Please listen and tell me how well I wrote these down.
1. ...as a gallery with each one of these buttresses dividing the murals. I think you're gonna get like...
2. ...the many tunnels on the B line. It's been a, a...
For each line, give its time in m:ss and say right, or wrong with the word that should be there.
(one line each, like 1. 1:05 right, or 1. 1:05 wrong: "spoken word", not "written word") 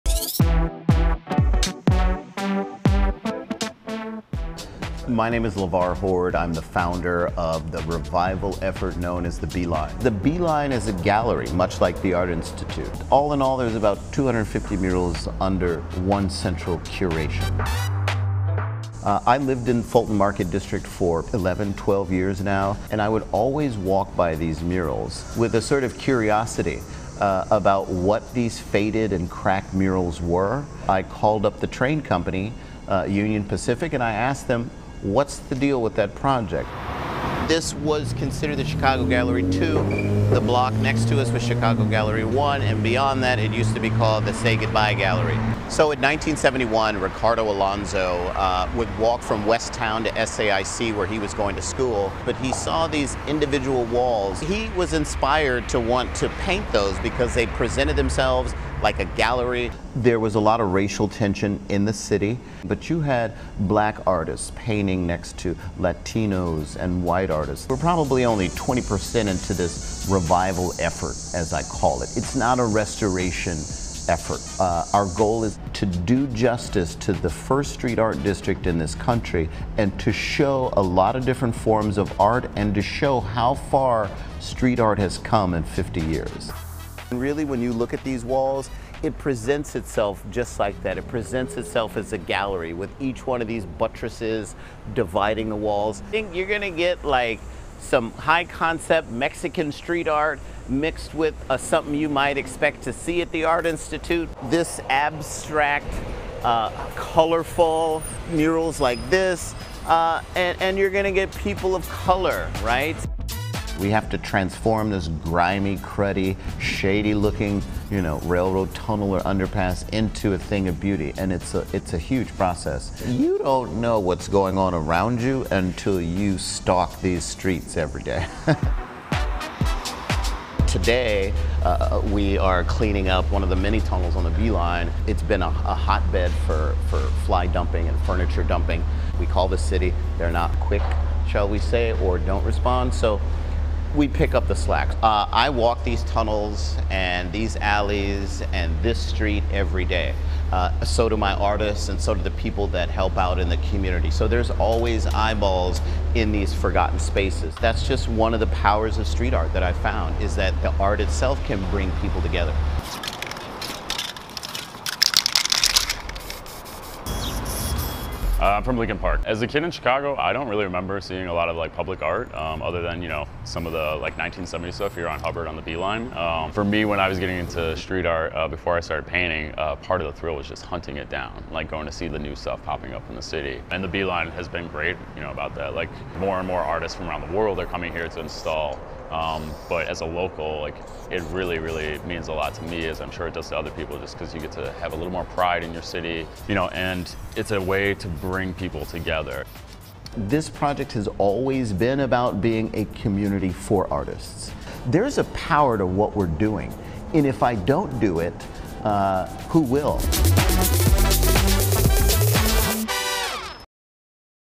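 1. 1:31 wrong: "walls", not "murals"
2. 2:13 right.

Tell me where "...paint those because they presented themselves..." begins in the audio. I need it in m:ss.
0:56.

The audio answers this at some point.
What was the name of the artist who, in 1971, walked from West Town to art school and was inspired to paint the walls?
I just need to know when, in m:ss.
0:46.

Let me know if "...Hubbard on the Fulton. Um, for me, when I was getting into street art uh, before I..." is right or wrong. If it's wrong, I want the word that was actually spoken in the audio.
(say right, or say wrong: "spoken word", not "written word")
wrong: "Beeline", not "Fulton".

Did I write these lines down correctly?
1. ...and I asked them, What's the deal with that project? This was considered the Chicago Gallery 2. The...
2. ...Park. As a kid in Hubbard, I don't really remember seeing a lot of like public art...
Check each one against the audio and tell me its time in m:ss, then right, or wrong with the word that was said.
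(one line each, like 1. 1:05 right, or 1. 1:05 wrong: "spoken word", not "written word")
1. 0:33 right
2. 2:48 wrong: "Chicago", not "Hubbard".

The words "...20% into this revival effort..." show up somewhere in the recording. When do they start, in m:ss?
1:08.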